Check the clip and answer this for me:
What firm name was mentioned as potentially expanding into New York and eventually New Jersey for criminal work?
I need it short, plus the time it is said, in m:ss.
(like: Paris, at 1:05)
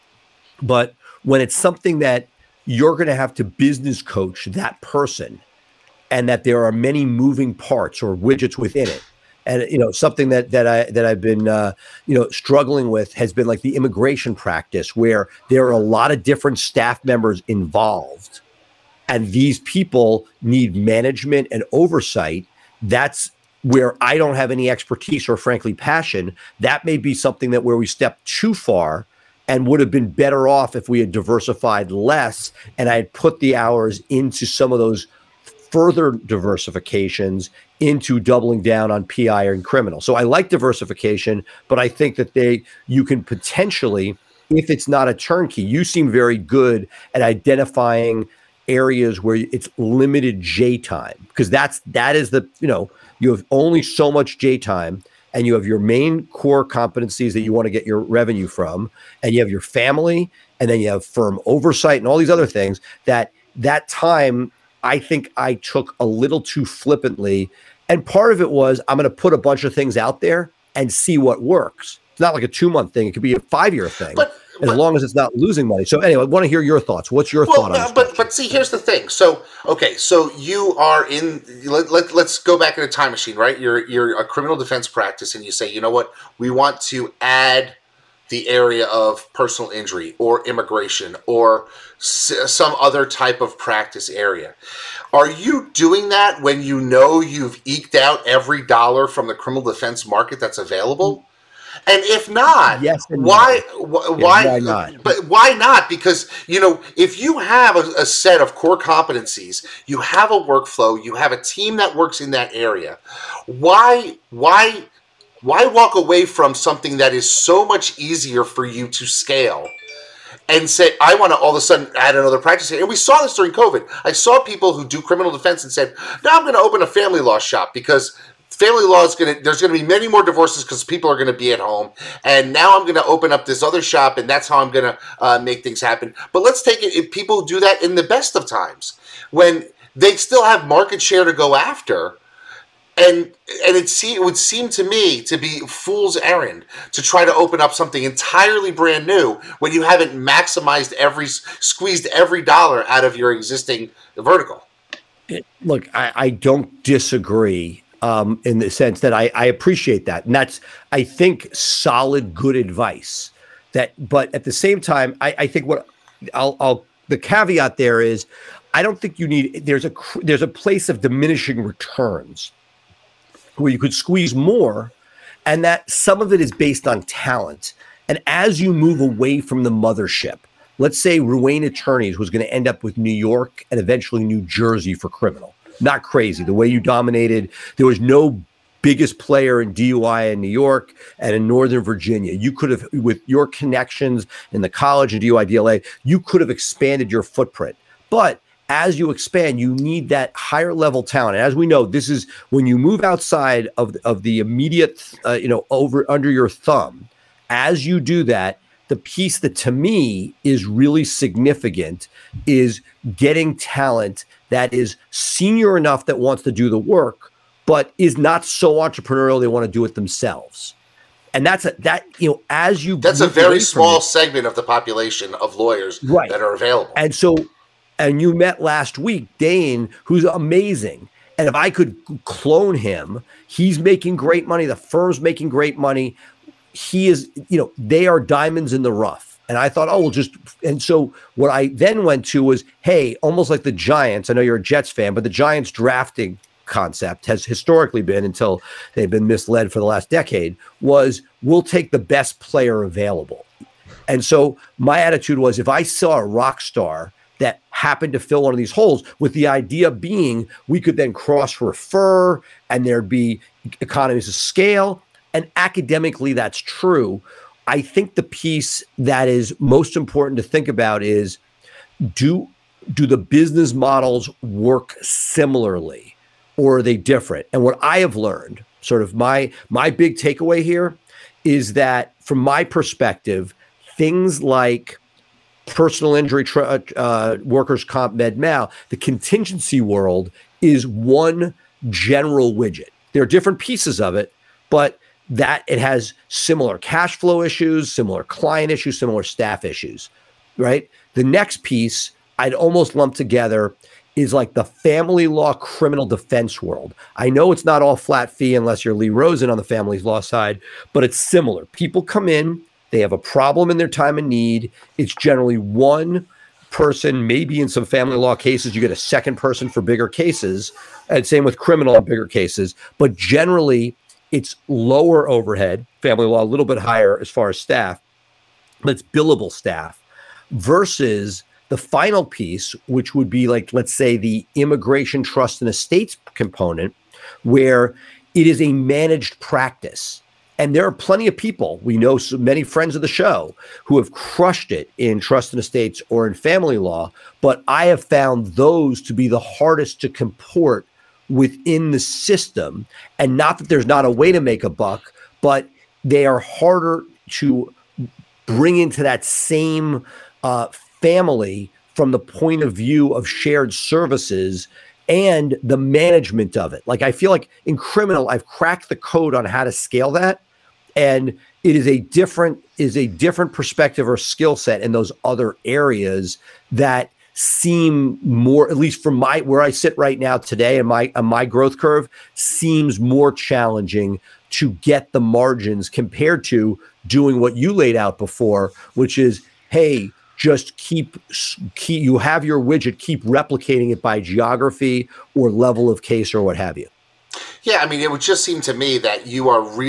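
Ruane Attorneys, at 3:01.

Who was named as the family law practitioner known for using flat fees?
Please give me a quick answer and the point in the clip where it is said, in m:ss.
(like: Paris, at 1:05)
Lee Rosen, at 5:08.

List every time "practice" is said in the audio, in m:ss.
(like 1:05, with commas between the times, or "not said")
0:14, 1:24, 1:33, 2:02, 5:39.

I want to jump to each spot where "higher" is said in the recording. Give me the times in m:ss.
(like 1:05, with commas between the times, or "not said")
3:20, 5:26.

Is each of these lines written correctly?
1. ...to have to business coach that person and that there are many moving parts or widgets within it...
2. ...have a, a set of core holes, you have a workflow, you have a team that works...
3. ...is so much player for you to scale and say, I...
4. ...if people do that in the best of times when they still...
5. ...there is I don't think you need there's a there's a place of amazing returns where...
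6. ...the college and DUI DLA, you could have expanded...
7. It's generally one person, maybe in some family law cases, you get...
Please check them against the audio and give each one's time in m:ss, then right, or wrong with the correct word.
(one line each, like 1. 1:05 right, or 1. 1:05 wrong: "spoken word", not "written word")
1. 0:03 right
2. 1:47 wrong: "competencies", not "holes"
3. 1:57 wrong: "easier", not "player"
4. 2:16 right
5. 2:47 wrong: "diminishing", not "amazing"
6. 3:14 right
7. 5:14 right.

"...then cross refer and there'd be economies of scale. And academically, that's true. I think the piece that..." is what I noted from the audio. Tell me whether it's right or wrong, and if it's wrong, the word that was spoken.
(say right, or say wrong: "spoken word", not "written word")
right.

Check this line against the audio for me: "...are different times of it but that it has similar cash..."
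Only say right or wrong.
wrong.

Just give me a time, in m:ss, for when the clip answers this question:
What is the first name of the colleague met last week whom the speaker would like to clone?
3:49.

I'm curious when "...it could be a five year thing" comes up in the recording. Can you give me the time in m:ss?
1:13.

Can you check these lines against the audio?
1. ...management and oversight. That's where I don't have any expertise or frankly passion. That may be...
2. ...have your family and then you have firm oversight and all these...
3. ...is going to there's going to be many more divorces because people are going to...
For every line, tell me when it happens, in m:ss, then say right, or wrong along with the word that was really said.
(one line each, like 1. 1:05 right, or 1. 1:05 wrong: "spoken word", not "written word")
1. 0:20 right
2. 0:59 right
3. 2:09 right.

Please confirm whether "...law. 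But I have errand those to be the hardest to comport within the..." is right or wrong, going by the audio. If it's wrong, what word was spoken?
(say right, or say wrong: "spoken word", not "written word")
wrong: "found", not "errand".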